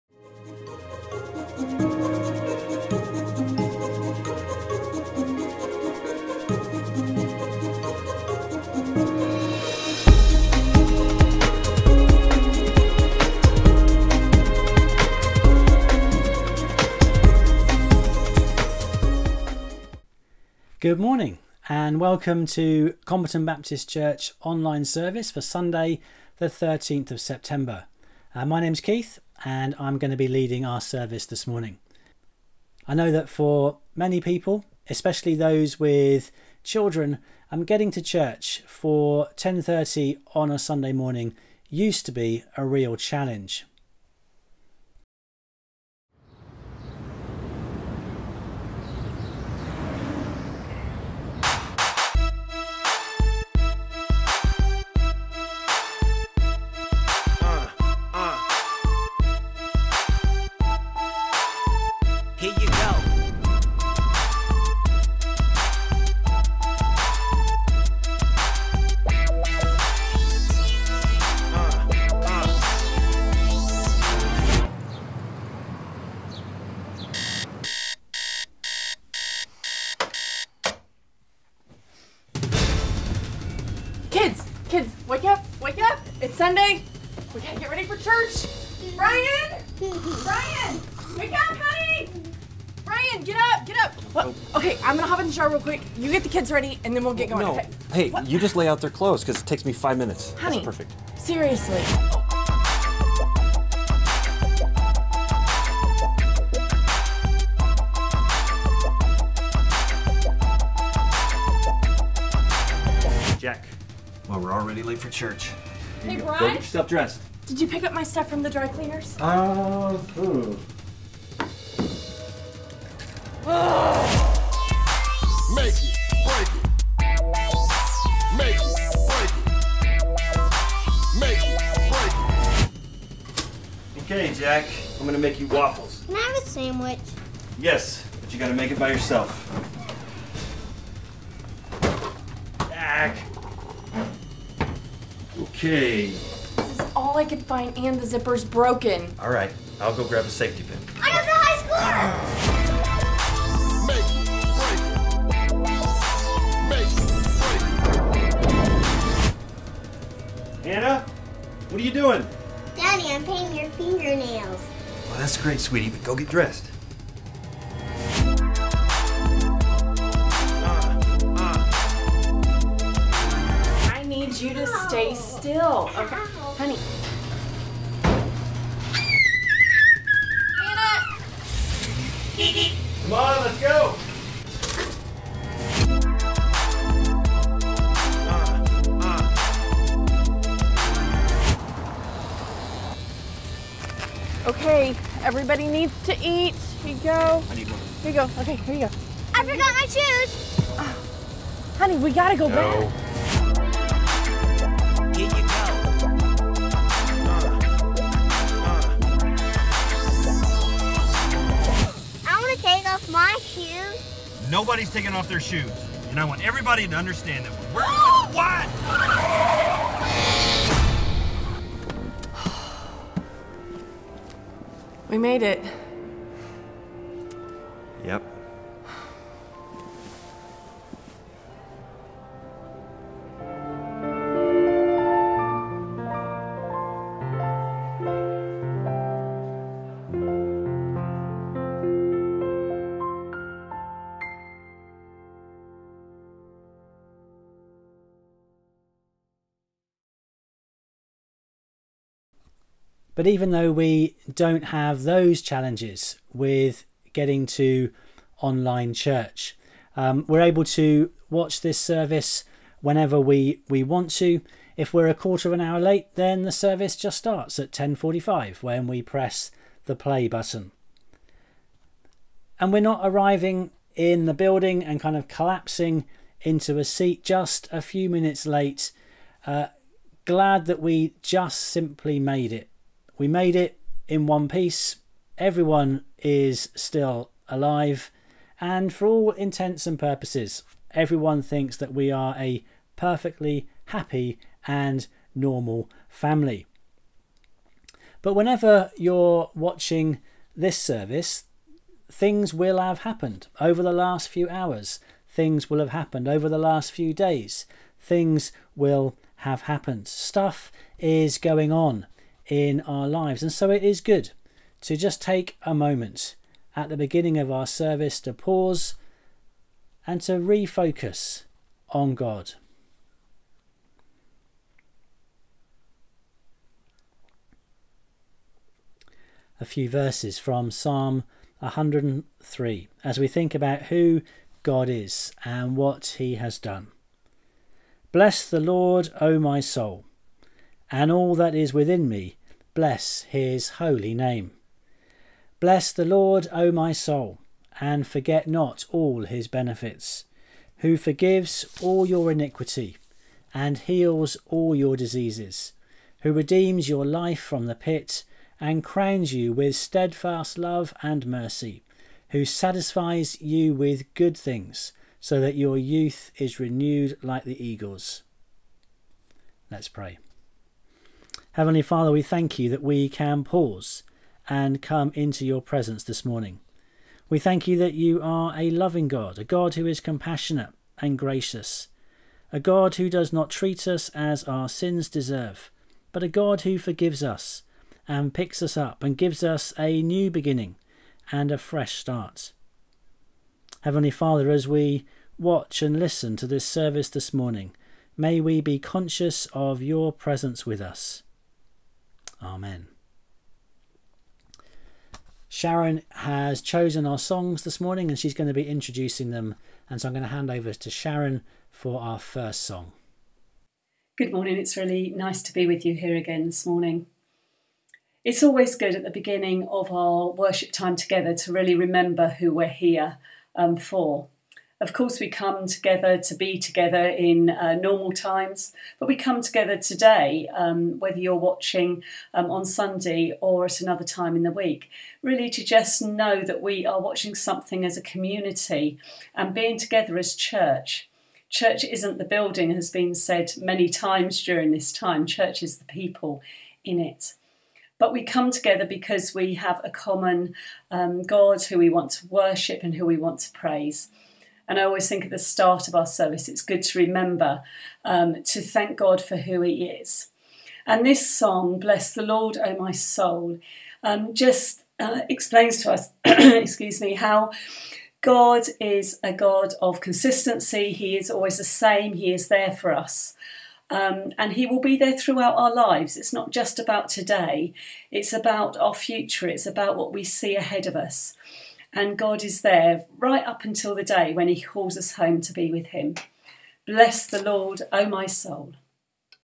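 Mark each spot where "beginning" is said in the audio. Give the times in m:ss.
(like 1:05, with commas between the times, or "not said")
5:16, 6:30, 6:59.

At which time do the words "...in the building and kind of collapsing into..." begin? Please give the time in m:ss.
4:33.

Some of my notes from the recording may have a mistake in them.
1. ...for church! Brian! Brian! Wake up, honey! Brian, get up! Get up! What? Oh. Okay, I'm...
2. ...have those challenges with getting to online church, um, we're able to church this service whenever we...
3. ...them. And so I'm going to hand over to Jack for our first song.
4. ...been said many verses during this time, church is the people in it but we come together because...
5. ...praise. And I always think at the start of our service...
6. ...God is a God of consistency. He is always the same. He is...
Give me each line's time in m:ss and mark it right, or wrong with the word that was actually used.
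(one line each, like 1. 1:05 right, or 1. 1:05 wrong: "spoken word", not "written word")
1. 1:27 right
2. 4:14 wrong: "watch", not "church"
3. 6:49 wrong: "Sharon", not "Jack"
4. 7:22 wrong: "times", not "verses"
5. 7:33 right
6. 7:48 right.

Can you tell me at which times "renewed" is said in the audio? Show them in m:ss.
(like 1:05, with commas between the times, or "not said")
6:06.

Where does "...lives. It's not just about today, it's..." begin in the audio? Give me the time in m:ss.
7:55.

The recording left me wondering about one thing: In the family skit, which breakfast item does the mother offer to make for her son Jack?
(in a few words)
Waffles.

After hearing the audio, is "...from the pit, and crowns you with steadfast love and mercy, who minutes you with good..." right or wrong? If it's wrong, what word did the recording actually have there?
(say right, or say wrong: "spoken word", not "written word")
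wrong: "satisfies", not "minutes".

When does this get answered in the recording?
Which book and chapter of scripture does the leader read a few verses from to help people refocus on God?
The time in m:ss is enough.
5:30.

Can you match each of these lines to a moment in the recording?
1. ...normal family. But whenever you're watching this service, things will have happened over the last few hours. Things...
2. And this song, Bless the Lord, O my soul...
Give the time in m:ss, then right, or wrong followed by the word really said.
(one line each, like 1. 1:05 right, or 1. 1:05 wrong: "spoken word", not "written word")
1. 4:55 right
2. 7:40 right.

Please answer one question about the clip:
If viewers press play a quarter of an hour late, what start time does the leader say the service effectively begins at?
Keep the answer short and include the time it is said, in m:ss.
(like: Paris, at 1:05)
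10:45, at 4:27.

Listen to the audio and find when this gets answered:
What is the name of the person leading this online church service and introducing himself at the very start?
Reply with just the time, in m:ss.
0:28.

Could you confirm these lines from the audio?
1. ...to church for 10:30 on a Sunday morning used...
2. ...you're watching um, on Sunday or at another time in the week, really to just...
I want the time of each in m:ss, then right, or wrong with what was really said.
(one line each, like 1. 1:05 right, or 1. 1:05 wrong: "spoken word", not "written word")
1. 0:37 right
2. 7:11 right.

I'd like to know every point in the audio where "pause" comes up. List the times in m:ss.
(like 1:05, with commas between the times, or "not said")
5:18, 6:13.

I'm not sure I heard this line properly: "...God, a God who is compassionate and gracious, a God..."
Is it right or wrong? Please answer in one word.
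right.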